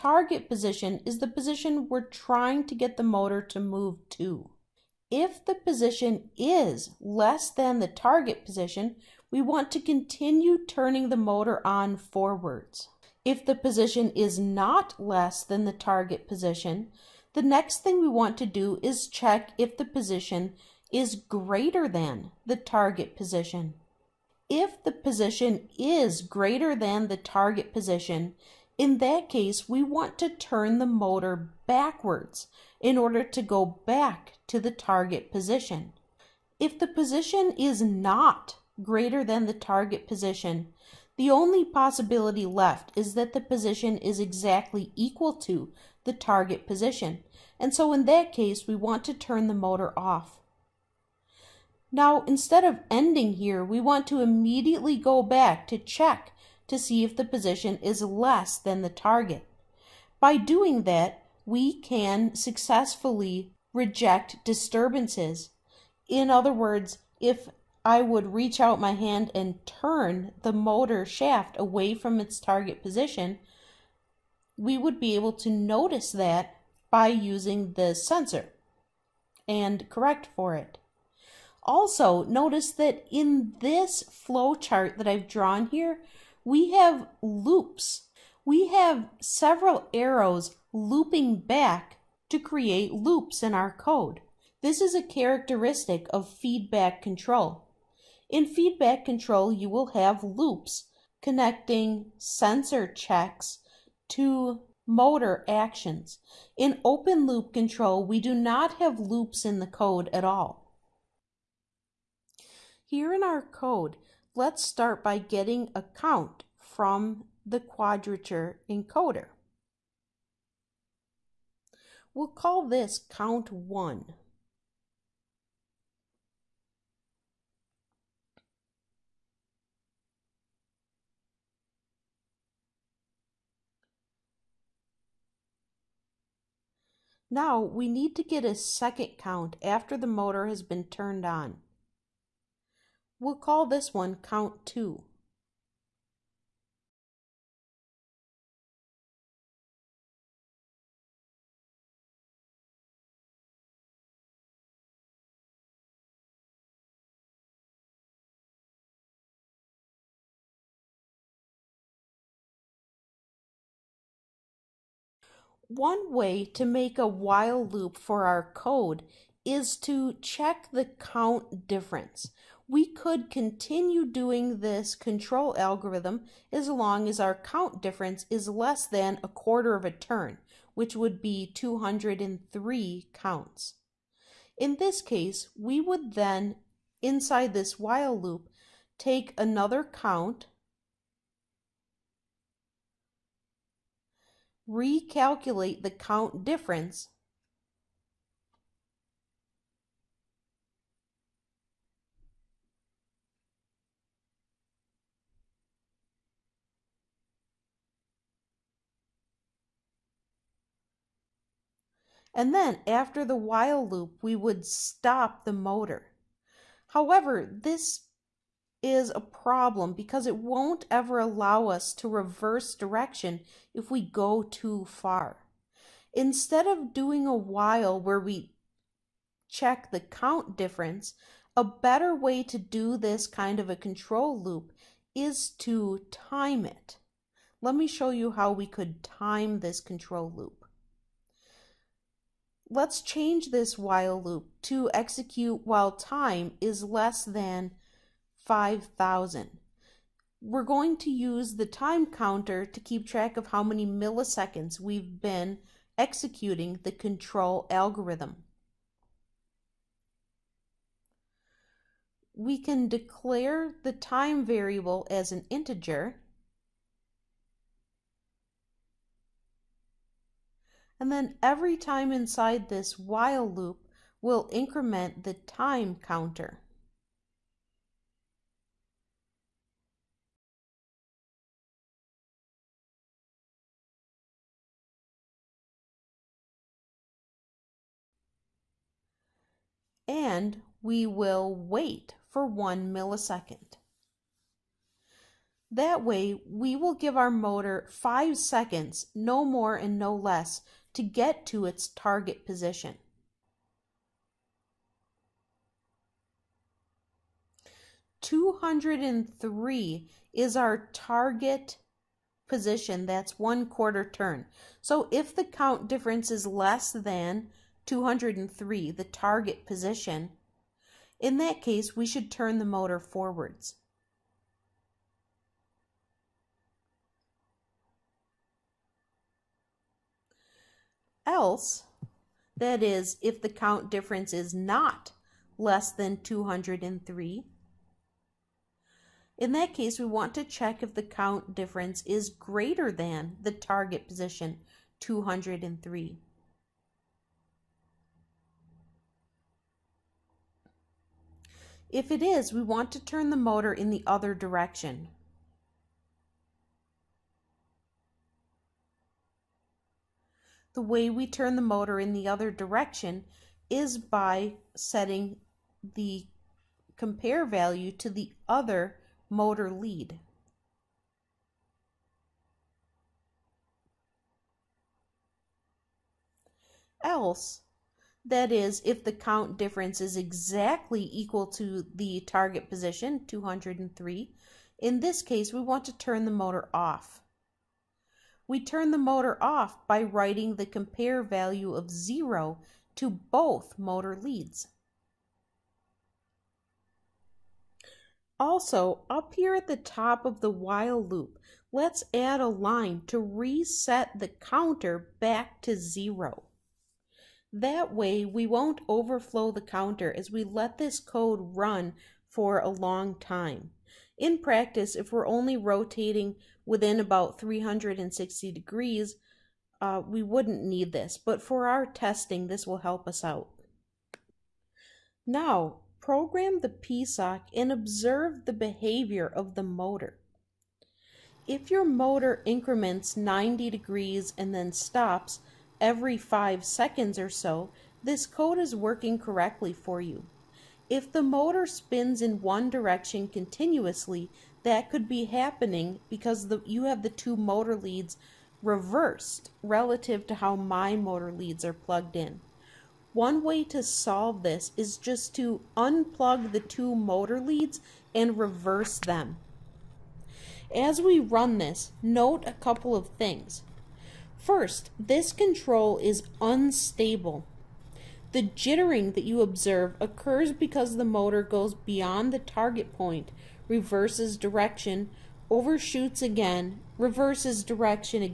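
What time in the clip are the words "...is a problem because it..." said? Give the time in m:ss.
3:38.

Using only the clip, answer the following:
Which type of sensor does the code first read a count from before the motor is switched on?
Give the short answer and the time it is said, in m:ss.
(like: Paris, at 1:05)
Quadrature encoder, at 1:57.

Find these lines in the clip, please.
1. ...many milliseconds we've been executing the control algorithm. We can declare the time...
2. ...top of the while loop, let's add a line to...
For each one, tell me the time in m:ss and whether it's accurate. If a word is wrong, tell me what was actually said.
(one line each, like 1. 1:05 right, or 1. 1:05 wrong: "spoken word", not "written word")
1. 4:13 right
2. 6:39 right.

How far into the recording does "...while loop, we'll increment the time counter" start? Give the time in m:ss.
4:32.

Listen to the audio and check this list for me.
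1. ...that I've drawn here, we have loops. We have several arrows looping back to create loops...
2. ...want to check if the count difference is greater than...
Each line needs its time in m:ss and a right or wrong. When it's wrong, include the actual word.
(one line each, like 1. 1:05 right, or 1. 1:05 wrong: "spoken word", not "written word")
1. 1:24 right
2. 5:40 right.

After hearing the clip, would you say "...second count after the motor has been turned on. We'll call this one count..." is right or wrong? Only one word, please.
right.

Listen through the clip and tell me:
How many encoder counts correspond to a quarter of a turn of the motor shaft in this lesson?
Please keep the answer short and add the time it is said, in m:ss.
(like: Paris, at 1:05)
203, at 3:01.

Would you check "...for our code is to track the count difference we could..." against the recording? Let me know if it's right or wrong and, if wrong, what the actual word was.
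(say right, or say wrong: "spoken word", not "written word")
wrong: "check", not "track".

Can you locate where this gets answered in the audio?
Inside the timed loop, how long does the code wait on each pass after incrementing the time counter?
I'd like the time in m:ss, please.
4:52.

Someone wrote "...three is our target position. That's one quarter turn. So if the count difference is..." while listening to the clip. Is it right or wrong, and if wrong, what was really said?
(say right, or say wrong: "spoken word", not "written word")
right.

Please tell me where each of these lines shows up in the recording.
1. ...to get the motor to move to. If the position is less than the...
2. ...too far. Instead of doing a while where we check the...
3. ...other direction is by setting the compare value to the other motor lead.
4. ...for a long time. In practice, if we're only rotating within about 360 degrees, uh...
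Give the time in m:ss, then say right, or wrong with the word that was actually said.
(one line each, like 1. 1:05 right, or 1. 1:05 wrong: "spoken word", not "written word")
1. 0:02 right
2. 3:44 right
3. 6:02 right
4. 6:52 right.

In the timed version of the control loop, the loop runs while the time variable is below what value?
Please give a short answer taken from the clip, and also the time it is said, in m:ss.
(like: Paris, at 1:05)
5,000, at 4:08.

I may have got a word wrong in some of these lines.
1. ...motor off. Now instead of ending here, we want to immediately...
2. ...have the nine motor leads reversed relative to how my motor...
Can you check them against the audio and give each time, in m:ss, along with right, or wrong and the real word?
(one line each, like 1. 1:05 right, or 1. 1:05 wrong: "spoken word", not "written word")
1. 0:49 right
2. 7:26 wrong: "two", not "nine".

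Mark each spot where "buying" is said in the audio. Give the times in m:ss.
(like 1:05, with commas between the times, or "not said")
not said.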